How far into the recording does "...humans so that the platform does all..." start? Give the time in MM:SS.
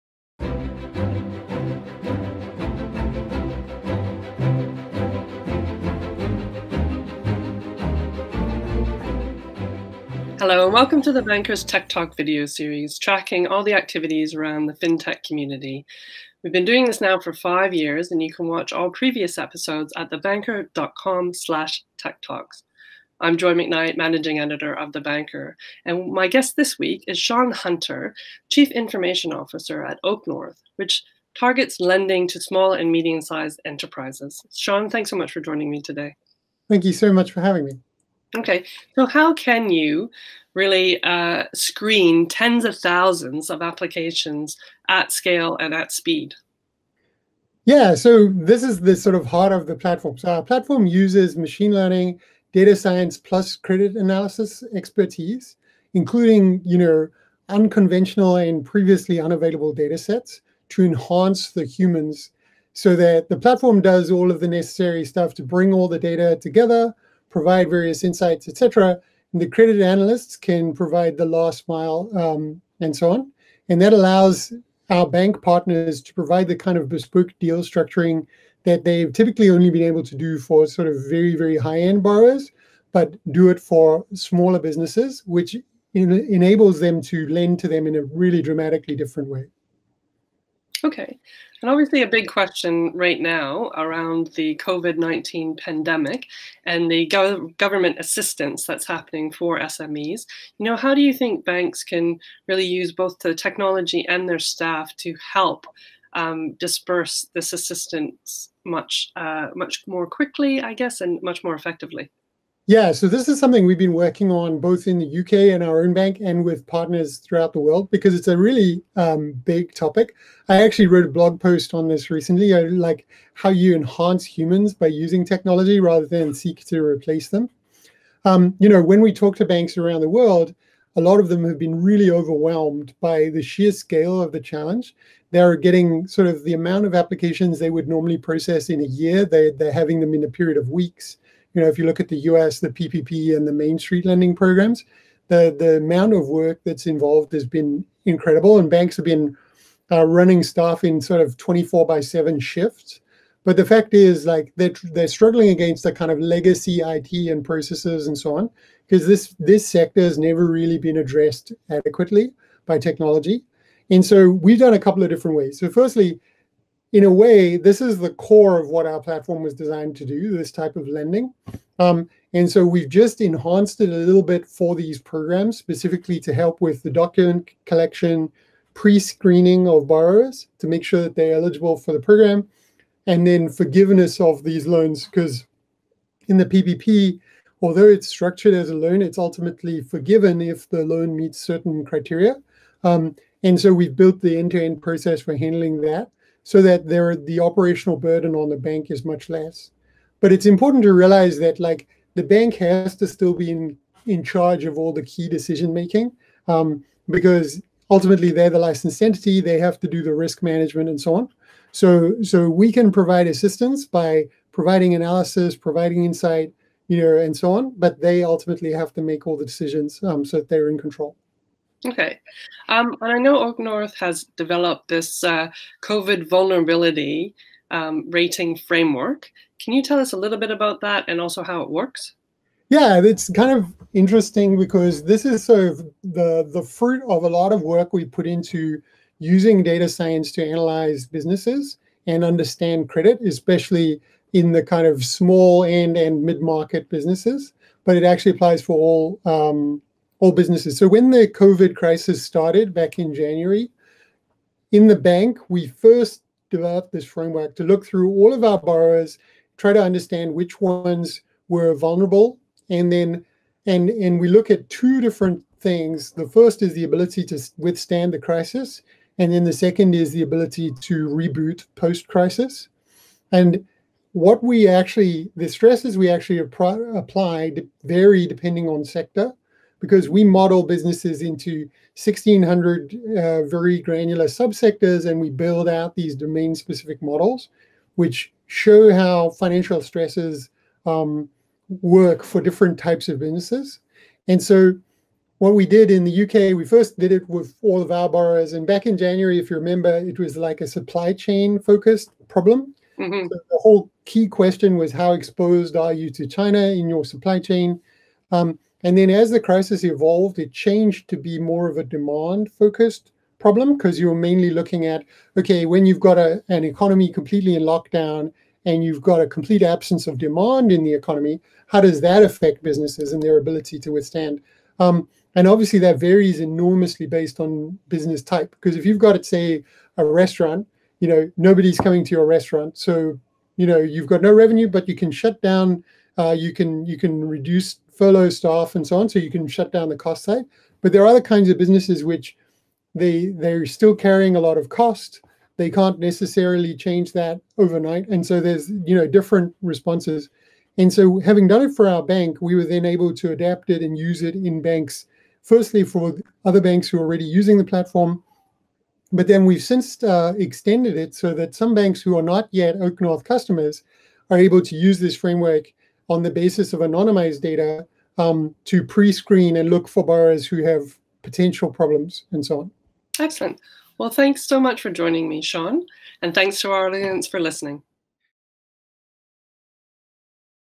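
01:01.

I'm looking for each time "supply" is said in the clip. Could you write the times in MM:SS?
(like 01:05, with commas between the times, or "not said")
05:00, 05:07.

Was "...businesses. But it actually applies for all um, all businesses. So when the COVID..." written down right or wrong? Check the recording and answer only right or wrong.
right.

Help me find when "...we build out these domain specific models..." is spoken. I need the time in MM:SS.
04:45.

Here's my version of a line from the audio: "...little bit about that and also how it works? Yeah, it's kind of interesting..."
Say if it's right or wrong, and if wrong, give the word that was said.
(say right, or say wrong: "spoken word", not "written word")
right.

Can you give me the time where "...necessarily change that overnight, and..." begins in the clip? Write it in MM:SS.
05:45.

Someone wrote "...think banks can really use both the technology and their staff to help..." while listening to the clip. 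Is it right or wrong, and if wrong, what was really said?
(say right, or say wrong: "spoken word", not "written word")
right.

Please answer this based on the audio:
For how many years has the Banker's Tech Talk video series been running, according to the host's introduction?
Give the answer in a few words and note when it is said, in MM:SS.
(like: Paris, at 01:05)
5, at 00:17.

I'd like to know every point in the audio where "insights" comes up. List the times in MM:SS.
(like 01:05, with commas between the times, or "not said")
01:08, 03:36.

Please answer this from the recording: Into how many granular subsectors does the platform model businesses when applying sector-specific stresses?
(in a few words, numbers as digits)
1600.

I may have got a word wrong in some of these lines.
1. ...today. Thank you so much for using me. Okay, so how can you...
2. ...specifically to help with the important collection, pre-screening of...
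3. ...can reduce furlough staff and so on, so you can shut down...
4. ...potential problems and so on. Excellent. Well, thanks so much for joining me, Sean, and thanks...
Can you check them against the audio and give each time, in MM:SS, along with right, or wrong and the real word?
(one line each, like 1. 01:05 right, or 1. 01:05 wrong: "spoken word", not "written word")
1. 00:35 wrong: "having", not "using"
2. 02:55 wrong: "document", not "important"
3. 05:36 right
4. 06:11 right.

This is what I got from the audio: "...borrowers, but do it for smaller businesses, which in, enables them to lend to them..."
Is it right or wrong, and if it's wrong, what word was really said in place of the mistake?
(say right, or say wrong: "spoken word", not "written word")
right.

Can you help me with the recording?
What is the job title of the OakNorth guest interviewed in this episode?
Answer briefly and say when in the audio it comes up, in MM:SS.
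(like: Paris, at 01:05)
Chief Information Officer, at 00:28.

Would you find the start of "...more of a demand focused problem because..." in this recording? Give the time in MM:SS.
05:11.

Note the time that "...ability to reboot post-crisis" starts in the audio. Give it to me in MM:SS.
04:30.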